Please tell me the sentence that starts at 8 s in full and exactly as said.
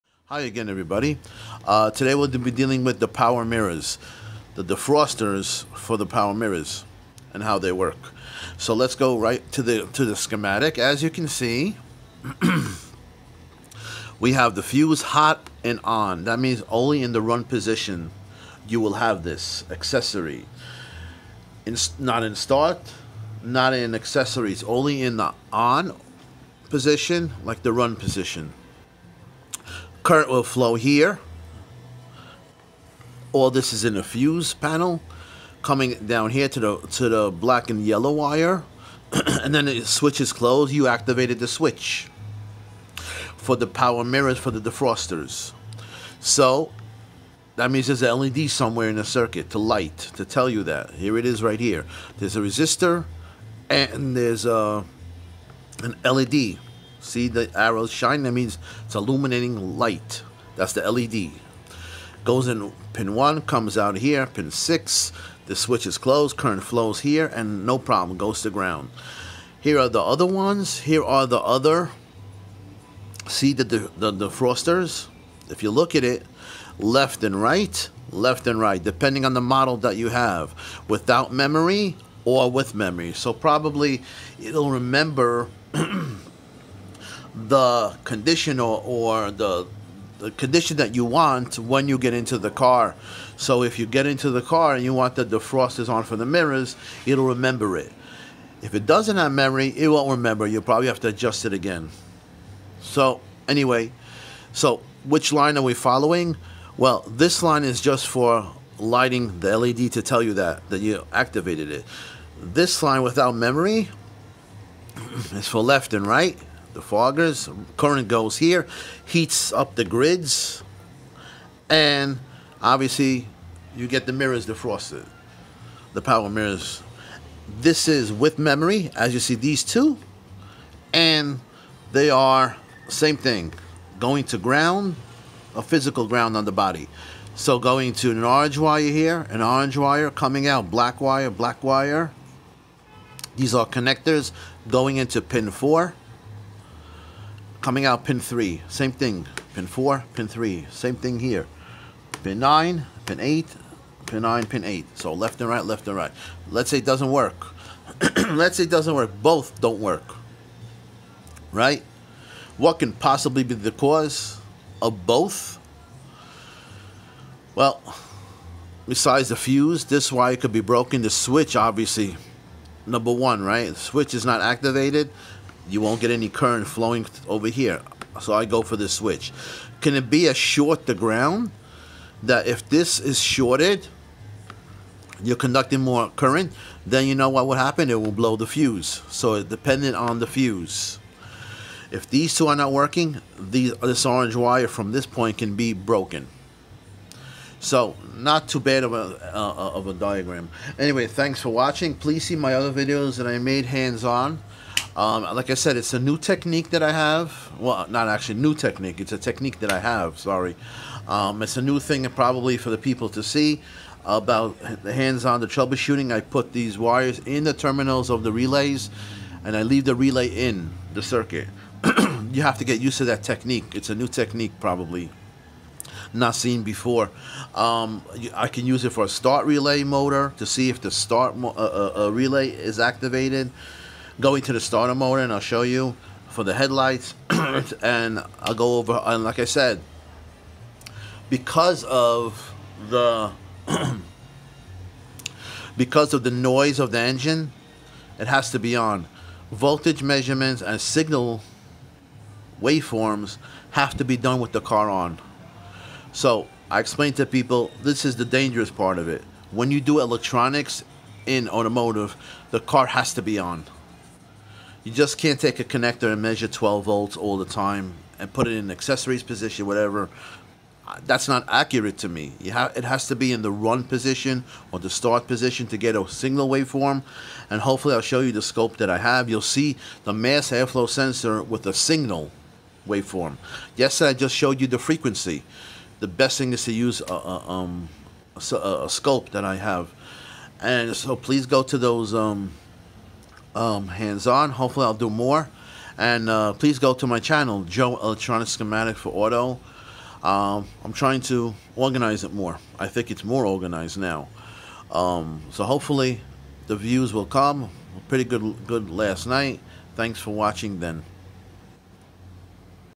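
So let's go right to the to the schematic.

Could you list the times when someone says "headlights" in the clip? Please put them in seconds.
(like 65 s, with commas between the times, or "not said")
236 s.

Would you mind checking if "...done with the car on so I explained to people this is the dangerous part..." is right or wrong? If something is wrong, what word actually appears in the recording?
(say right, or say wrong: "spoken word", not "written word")
right.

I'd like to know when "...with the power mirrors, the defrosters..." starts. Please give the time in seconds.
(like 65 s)
2 s.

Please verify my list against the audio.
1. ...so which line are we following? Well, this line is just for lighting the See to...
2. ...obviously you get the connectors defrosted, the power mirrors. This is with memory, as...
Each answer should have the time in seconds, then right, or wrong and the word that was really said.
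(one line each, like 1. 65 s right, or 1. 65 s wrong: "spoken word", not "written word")
1. 104 s wrong: "LED", not "See"
2. 122 s wrong: "mirrors", not "connectors".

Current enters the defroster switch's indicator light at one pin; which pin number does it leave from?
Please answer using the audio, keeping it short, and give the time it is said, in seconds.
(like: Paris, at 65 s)
6, at 64 s.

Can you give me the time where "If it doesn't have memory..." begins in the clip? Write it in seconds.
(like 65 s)
98 s.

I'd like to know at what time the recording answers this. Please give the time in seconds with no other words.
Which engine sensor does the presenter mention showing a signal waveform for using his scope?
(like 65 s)
280 s.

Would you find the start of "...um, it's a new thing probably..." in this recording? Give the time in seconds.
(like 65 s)
211 s.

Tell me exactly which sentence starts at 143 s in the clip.
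These are connectors going into pin 4 coming out pin 3, same thing.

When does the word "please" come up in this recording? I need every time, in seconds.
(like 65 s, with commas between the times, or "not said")
201 s, 291 s, 296 s.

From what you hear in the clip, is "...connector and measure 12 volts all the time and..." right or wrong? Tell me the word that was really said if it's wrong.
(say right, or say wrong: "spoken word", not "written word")
right.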